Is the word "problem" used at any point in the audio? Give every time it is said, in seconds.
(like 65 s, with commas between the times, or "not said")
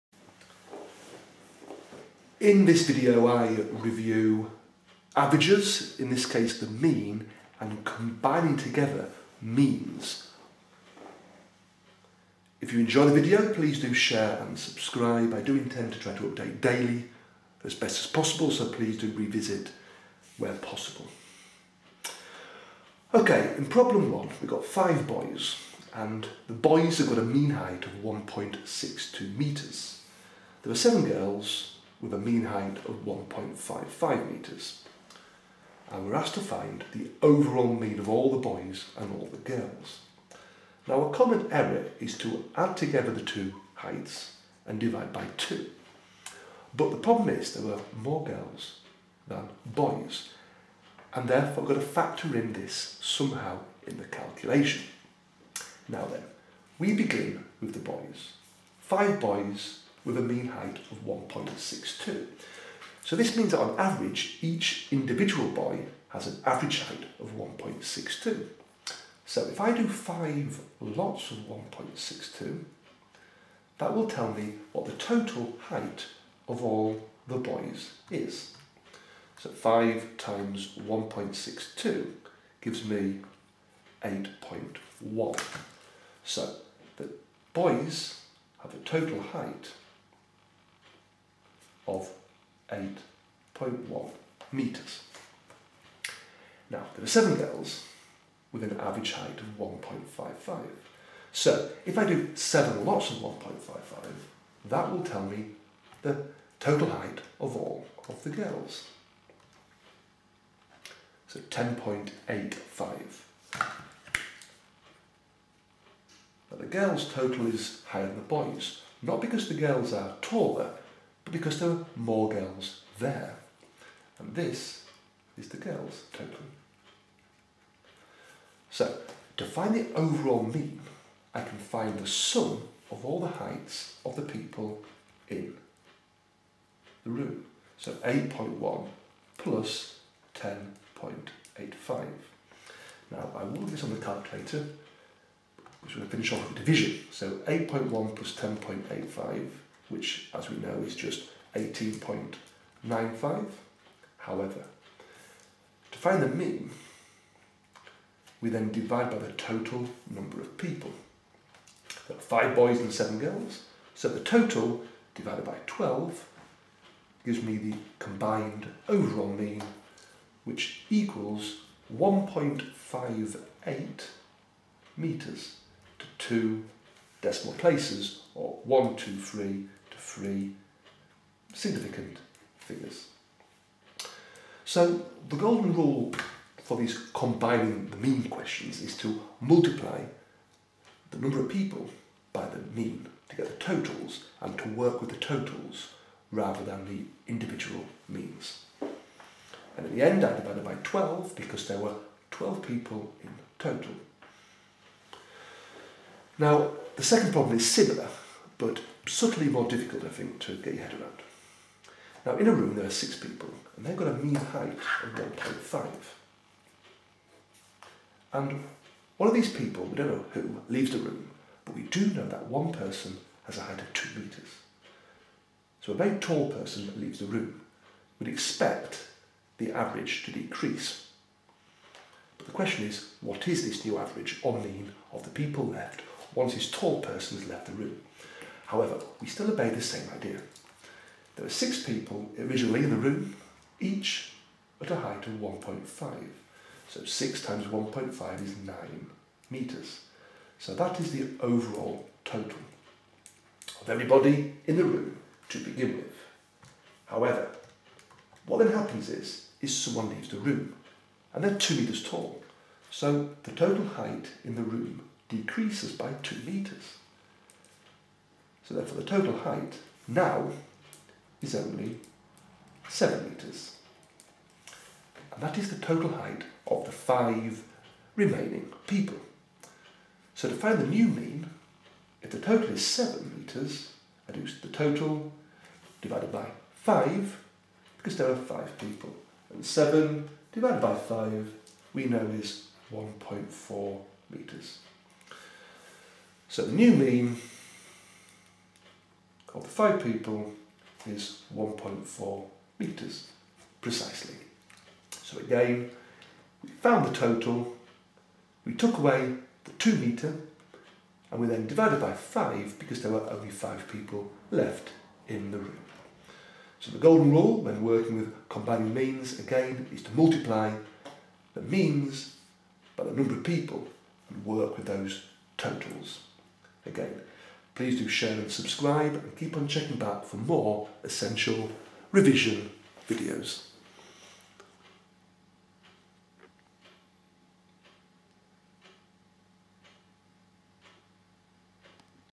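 23 s, 46 s, 207 s.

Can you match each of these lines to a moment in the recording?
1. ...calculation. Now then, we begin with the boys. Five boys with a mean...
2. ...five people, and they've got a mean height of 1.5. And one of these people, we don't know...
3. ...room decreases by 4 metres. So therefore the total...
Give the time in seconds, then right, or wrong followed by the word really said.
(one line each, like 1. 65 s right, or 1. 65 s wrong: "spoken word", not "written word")
1. 54 s right
2. 212 s wrong: "six", not "five"
3. 264 s wrong: "2", not "4".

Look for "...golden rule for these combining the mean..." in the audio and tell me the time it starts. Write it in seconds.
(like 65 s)
185 s.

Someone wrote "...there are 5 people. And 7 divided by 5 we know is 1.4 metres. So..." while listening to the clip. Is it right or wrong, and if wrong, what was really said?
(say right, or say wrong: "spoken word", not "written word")
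right.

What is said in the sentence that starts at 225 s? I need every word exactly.
So a very tall person leaves the room.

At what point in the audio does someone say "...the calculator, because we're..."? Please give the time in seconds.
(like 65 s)
143 s.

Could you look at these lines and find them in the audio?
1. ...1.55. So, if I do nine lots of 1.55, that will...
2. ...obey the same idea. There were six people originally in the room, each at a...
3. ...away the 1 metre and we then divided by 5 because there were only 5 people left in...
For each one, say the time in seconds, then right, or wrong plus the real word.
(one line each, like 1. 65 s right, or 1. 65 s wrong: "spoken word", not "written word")
1. 99 s wrong: "seven", not "nine"
2. 239 s right
3. 308 s wrong: "2", not "1".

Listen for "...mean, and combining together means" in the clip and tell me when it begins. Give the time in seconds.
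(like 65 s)
6 s.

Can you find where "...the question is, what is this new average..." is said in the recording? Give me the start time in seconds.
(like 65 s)
232 s.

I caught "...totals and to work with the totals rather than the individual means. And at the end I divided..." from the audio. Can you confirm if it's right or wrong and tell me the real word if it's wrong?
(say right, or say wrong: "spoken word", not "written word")
right.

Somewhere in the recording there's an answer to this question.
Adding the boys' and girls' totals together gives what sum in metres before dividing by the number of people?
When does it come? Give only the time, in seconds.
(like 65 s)
151 s.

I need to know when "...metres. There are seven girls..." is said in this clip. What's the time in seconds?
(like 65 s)
29 s.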